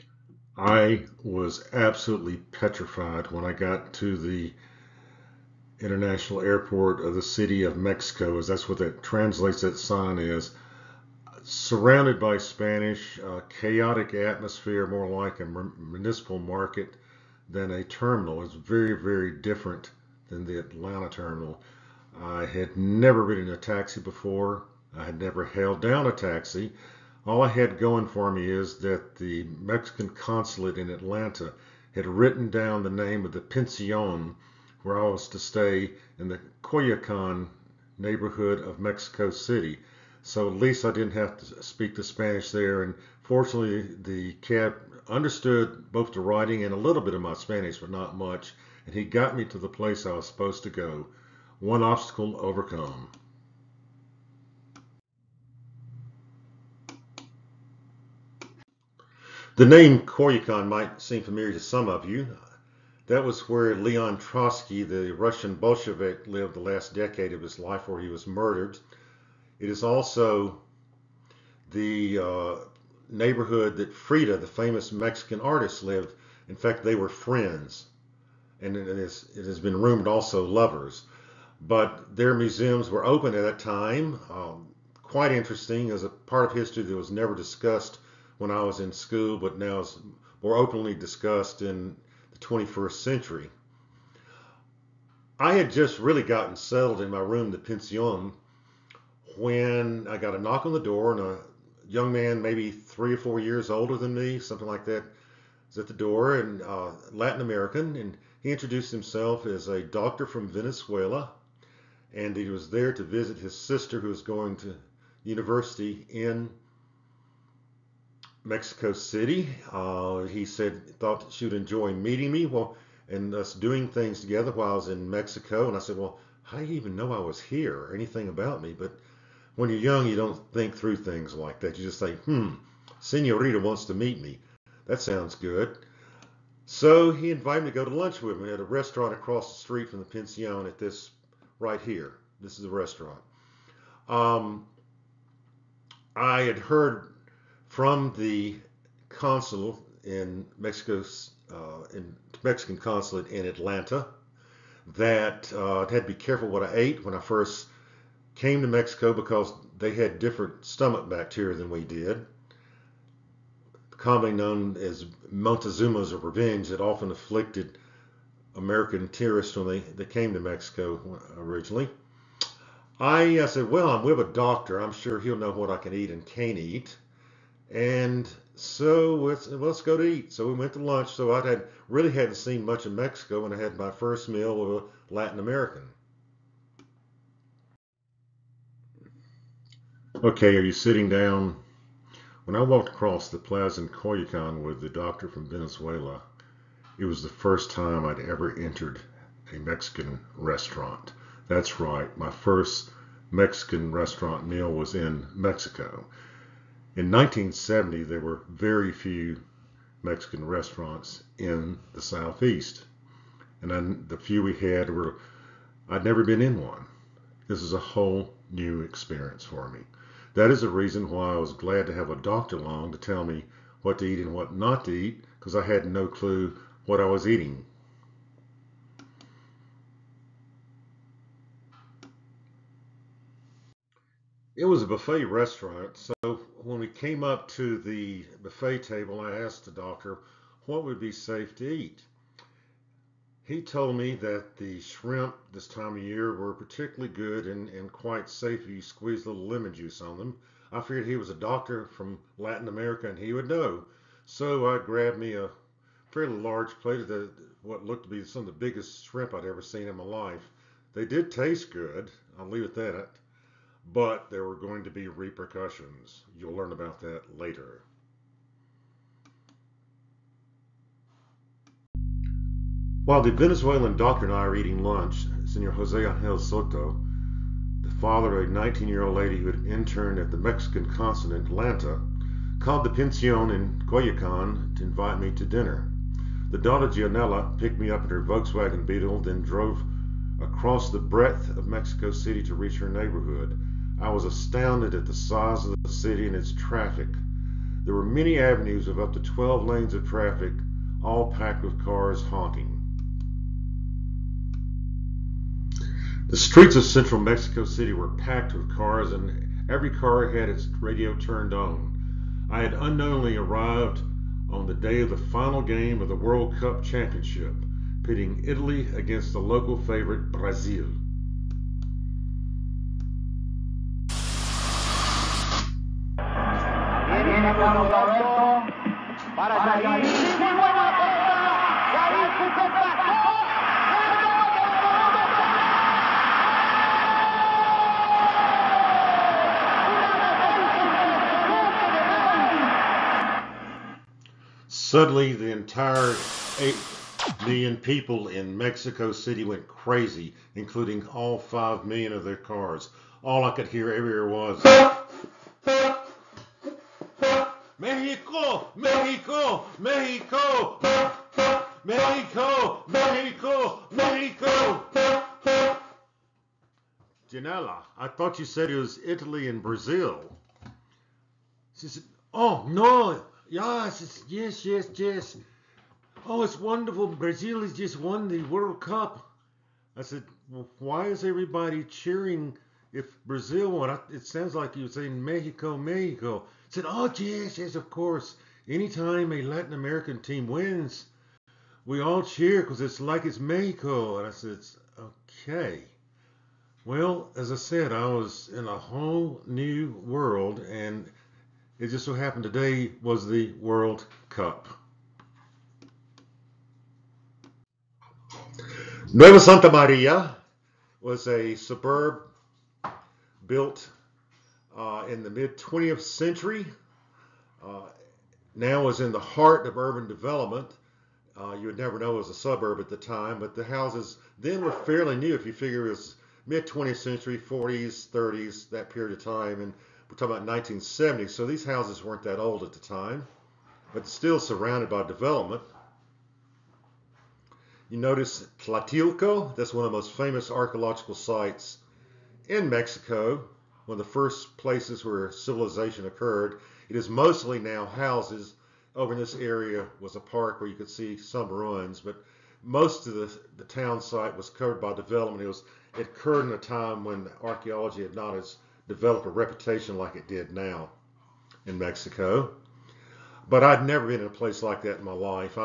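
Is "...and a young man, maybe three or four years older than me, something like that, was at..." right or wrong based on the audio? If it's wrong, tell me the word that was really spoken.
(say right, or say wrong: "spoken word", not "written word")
right.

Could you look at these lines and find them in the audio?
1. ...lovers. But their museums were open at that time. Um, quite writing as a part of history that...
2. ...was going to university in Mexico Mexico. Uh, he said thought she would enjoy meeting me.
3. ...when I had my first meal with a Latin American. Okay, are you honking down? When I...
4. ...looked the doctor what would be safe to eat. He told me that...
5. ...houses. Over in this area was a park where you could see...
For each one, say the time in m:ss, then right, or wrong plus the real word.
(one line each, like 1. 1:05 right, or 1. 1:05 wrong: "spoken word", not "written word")
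1. 1:20 wrong: "interesting", not "writing"
2. 1:54 wrong: "City", not "Mexico"
3. 3:03 wrong: "sitting", not "honking"
4. 3:59 wrong: "asked", not "looked"
5. 7:27 right.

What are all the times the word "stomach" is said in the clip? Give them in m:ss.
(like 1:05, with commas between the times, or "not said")
2:40.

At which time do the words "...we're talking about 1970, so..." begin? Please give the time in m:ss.
7:10.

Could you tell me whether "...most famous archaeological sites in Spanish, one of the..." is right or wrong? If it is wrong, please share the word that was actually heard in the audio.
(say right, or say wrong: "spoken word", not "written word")
wrong: "Mexico", not "Spanish".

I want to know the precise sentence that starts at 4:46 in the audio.
The daughter Gianella picked me up in her Volkswagen Beetle, then drove across the breadth of Mexico City to reach her neighborhood.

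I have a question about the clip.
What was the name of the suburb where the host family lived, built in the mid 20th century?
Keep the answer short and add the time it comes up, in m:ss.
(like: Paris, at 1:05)
Nueva Santa Maria, at 6:49.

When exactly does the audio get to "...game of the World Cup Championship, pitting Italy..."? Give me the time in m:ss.
5:15.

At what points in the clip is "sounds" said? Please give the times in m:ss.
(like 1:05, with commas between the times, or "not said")
2:15, 6:24.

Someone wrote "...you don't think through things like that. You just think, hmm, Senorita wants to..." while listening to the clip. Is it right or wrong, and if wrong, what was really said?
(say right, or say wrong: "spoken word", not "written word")
right.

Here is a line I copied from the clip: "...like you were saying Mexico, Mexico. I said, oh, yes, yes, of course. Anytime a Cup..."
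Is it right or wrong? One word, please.
wrong.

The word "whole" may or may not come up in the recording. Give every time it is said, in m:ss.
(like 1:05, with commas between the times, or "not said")
3:37, 6:38.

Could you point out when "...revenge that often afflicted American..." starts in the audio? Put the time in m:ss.
2:46.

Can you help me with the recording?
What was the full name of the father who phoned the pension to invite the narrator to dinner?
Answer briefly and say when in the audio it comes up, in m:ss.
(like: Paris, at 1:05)
Jose Angel Soto, at 4:35.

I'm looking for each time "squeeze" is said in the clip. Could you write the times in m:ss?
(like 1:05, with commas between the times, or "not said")
4:08.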